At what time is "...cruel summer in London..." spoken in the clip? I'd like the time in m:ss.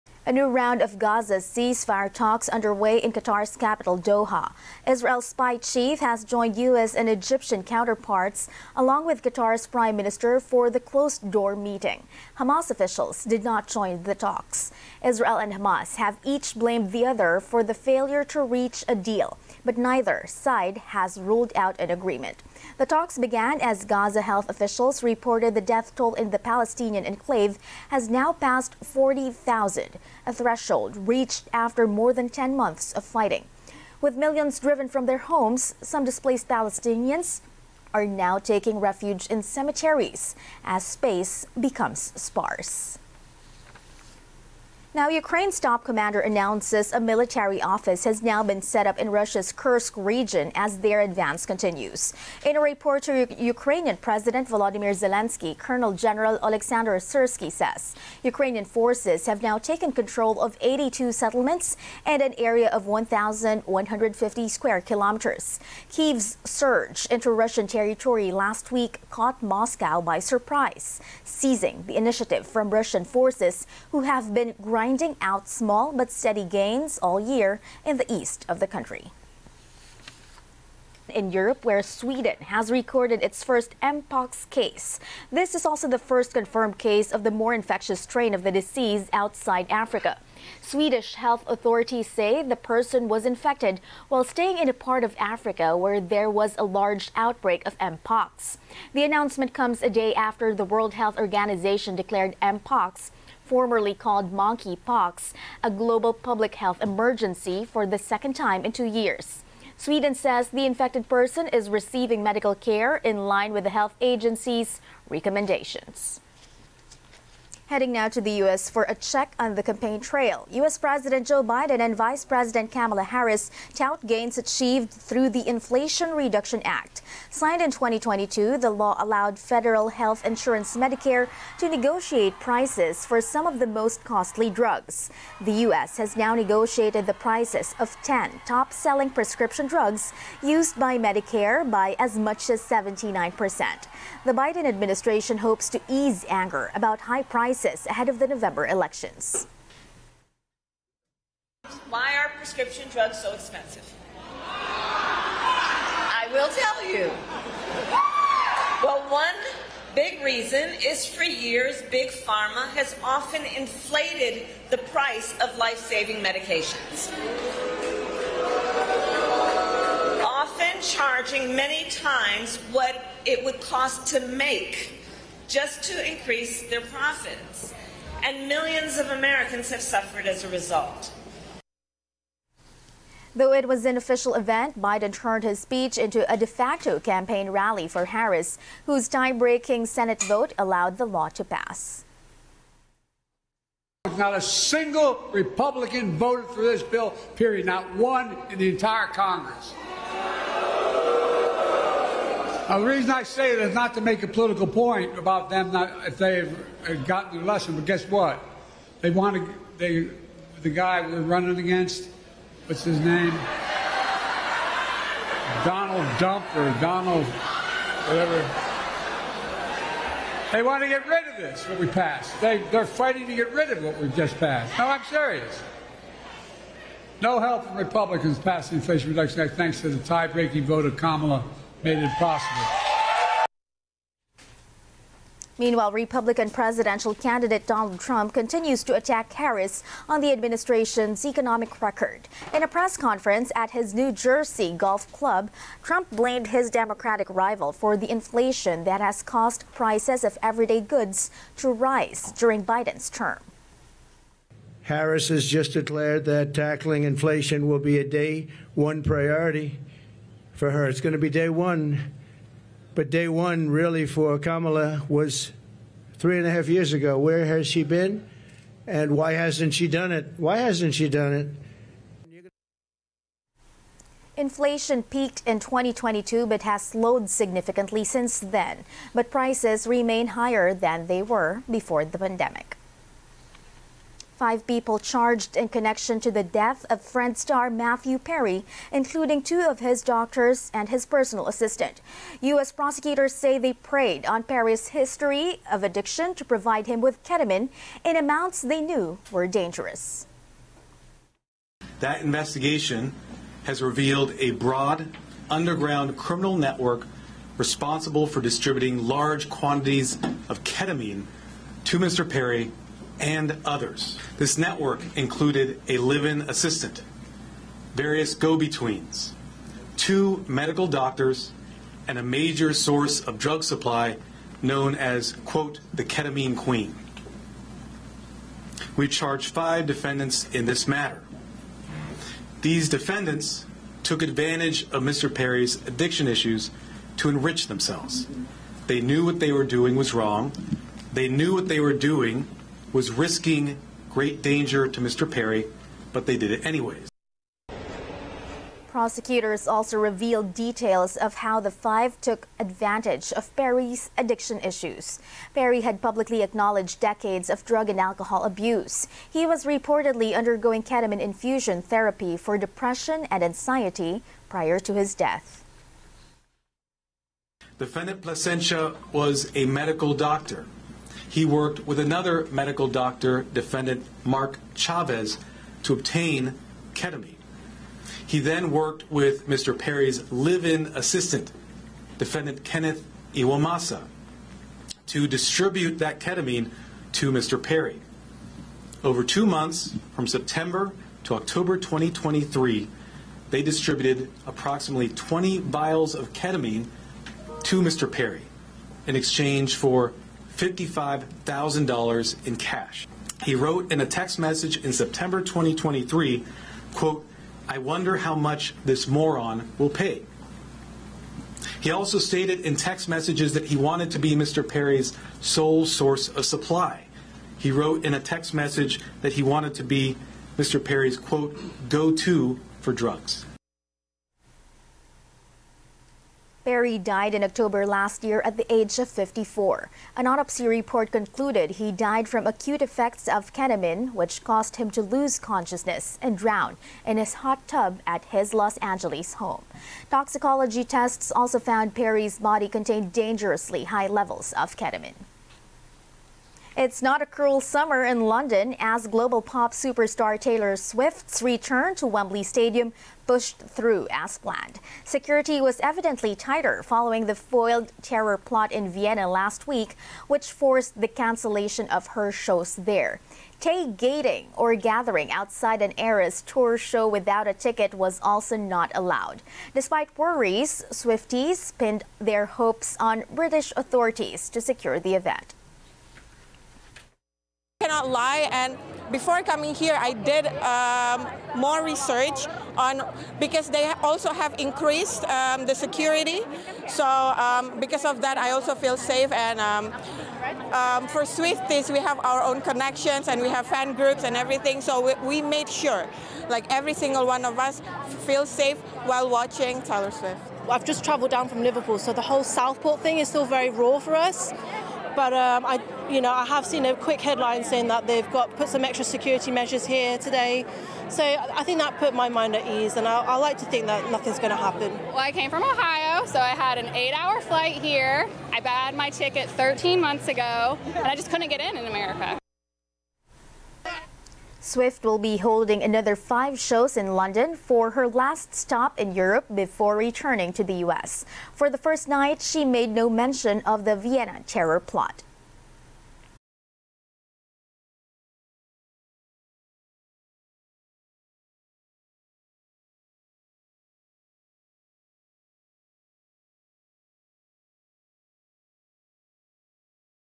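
7:27.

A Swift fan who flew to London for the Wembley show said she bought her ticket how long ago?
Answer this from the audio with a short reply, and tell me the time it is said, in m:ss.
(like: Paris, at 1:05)
13 months, at 8:39.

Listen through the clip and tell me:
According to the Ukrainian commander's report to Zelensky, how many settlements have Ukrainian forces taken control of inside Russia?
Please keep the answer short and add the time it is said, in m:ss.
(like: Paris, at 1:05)
82, at 1:00.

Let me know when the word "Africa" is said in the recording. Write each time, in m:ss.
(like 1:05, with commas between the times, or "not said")
1:29, 1:35.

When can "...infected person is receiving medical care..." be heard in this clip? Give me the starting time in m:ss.
1:50.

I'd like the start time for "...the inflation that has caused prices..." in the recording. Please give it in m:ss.
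4:07.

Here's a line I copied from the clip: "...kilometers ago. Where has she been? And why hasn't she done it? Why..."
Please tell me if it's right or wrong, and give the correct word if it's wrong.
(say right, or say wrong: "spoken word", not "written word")
wrong: "years", not "kilometers".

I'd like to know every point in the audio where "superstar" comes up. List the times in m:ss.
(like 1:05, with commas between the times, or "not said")
7:29.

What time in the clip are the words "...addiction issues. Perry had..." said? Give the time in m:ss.
5:54.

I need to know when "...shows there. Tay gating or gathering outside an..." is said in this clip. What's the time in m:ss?
7:42.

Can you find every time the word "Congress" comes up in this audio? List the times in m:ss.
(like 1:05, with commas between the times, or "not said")
3:19.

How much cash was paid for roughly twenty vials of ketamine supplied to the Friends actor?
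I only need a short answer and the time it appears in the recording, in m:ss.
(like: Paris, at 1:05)
$55,000, at 6:40.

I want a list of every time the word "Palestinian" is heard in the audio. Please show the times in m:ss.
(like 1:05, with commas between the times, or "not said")
0:26, 0:36.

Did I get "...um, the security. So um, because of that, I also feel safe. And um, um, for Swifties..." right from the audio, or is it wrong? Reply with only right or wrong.
right.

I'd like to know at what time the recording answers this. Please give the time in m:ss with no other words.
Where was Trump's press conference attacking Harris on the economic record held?
4:03.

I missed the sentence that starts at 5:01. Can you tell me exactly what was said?
That investigation has revealed a broad underground criminal network responsible for distributing large quantities of ketamine to Mr.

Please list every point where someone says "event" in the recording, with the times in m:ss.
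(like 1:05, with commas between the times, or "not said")
3:04, 7:55.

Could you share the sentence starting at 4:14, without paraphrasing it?
Harris has just declared that tackling inflation will be a day one priority for her.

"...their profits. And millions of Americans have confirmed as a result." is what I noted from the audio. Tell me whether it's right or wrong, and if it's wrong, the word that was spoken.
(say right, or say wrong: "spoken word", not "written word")
wrong: "suffered", not "confirmed".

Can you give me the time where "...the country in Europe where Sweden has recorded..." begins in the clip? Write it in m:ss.
1:18.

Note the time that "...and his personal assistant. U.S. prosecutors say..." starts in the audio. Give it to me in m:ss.
4:50.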